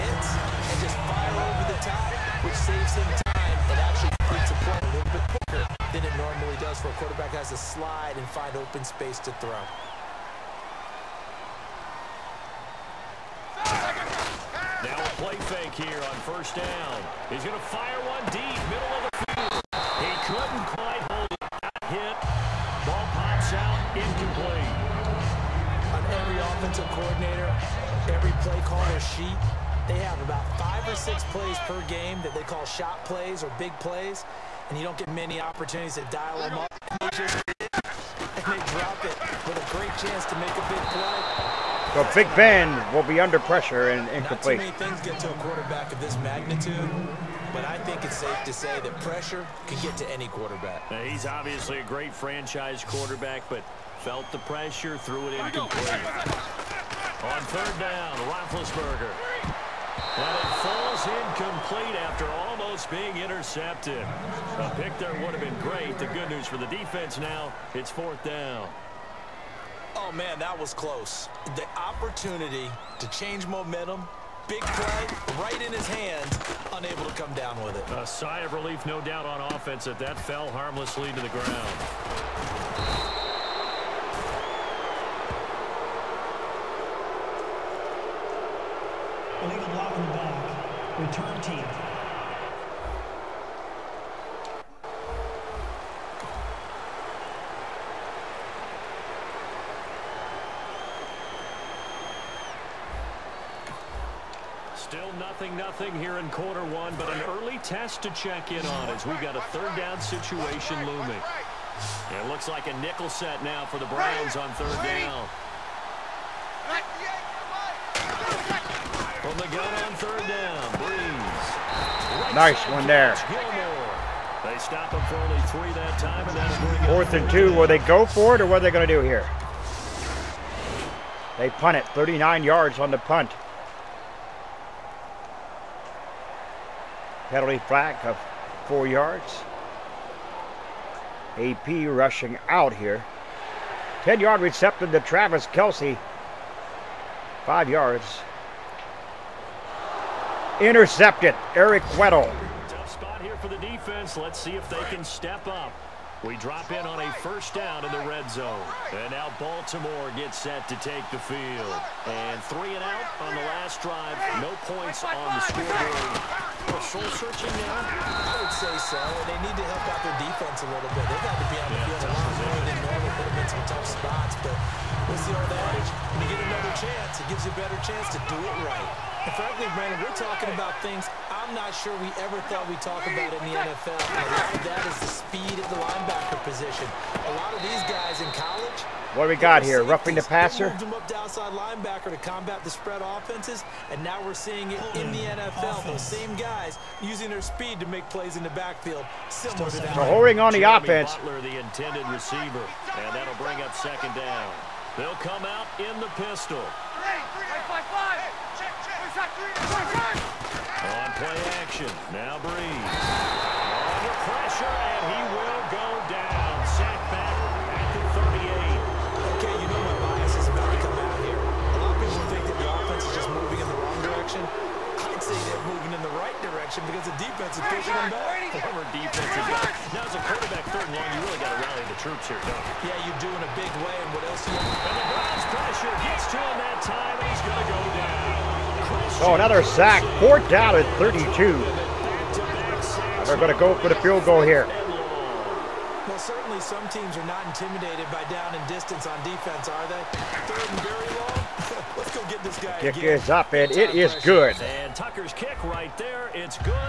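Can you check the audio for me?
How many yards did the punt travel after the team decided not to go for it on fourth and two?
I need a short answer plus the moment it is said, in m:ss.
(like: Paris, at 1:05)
39, at 2:11.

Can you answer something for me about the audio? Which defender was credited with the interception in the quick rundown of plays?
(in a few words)
Eric Weddle.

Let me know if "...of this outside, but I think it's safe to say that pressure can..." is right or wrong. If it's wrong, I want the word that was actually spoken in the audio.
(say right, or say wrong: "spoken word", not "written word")
wrong: "magnitude", not "outside".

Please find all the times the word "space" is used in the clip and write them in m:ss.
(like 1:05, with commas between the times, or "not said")
0:08.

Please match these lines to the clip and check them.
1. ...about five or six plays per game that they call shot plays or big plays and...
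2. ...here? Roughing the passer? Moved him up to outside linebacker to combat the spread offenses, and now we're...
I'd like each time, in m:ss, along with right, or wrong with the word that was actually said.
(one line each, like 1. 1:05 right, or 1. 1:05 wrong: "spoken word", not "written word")
1. 0:30 right
2. 3:09 right.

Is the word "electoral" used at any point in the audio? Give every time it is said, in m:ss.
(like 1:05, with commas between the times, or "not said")
not said.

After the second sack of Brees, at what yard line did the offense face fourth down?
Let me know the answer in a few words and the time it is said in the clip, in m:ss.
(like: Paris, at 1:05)
32, at 4:00.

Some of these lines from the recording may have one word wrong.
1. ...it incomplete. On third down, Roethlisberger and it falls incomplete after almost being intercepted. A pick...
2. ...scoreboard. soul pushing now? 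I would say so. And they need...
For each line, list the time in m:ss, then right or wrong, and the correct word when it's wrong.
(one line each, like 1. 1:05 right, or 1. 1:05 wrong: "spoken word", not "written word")
1. 0:55 right
2. 2:45 wrong: "searching", not "pushing".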